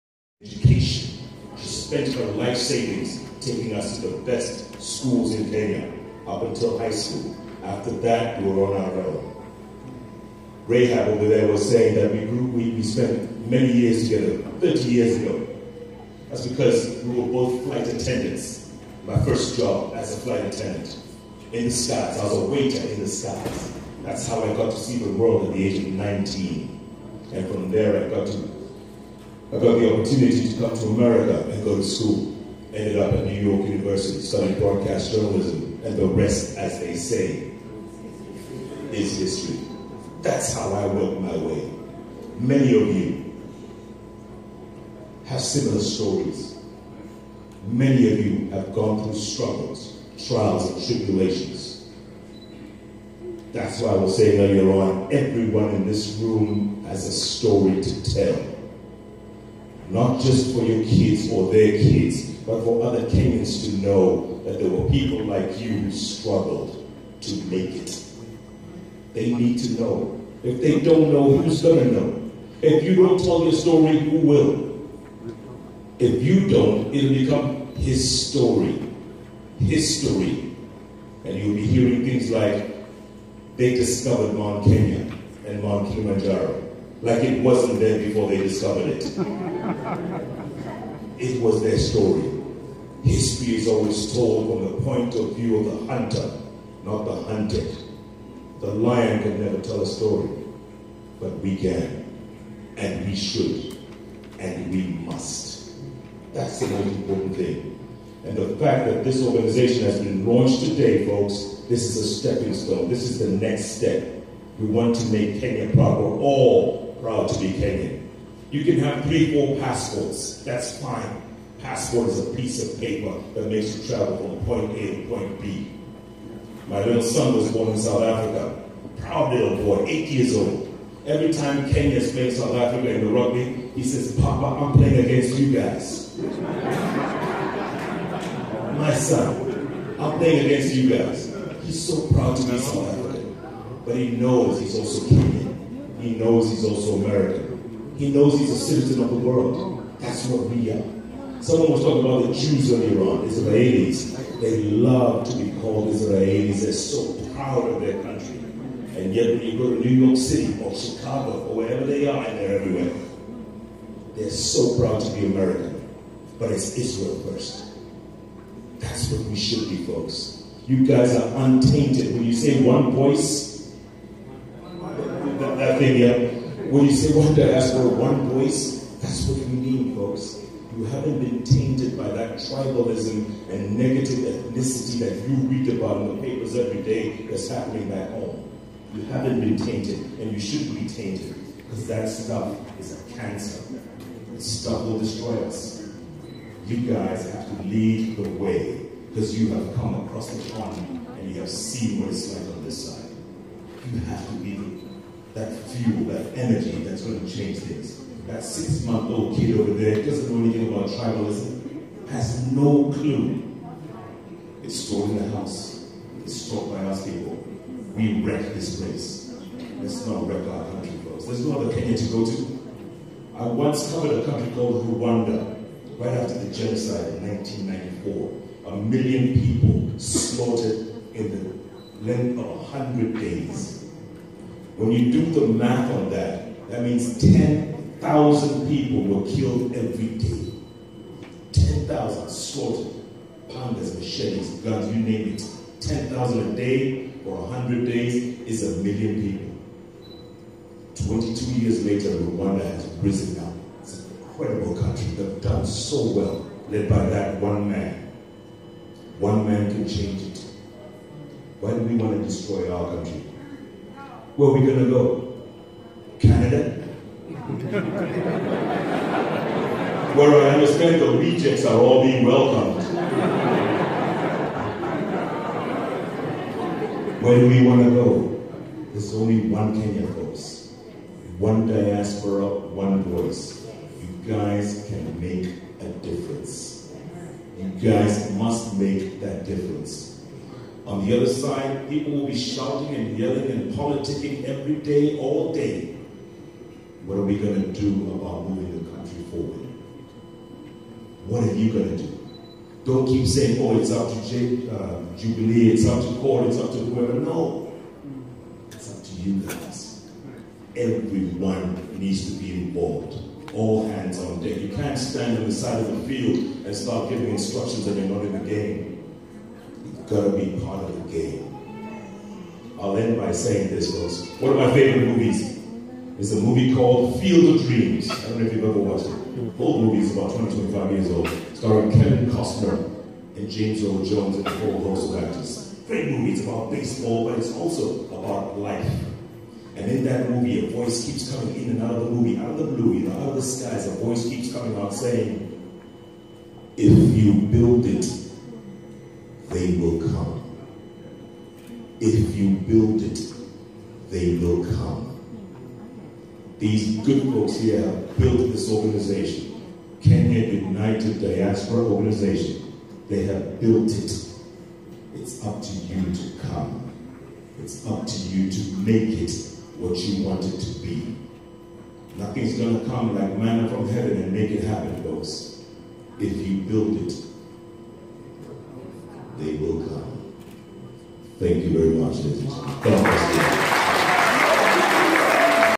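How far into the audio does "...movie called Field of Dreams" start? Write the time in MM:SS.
05:26.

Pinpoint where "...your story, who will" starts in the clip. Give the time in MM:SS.
01:13.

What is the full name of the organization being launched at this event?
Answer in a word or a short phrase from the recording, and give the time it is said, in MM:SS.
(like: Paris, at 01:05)
Kenya United Diaspora Organization, at 06:00.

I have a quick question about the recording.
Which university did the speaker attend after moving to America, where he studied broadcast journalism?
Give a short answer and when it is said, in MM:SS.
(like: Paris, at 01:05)
New York University, at 00:33.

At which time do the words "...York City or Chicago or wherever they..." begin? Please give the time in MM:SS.
02:40.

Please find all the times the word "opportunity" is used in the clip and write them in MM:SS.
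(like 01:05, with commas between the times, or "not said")
00:29.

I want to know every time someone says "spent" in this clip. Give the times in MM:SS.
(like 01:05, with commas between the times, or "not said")
00:01, 00:12.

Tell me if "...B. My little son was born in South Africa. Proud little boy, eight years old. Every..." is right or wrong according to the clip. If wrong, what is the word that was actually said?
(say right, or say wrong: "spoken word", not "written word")
right.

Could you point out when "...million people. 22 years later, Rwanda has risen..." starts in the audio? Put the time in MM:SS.
04:08.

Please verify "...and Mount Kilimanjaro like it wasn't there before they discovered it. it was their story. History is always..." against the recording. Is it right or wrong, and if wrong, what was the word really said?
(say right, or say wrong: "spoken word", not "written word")
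right.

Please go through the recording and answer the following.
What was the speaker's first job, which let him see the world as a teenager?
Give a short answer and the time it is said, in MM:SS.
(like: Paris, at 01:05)
Flight attendant, at 00:20.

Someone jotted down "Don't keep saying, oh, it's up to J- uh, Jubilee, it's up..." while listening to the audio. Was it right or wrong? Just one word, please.
right.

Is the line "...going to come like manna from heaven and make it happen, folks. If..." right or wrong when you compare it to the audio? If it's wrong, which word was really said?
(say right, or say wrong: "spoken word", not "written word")
right.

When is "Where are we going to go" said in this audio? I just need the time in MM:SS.
04:24.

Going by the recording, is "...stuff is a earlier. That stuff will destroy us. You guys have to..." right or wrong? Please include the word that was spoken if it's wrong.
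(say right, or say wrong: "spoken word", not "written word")
wrong: "cancer", not "earlier".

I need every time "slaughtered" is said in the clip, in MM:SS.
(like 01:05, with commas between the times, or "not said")
03:49, 04:02.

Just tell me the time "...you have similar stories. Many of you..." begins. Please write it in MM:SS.
00:42.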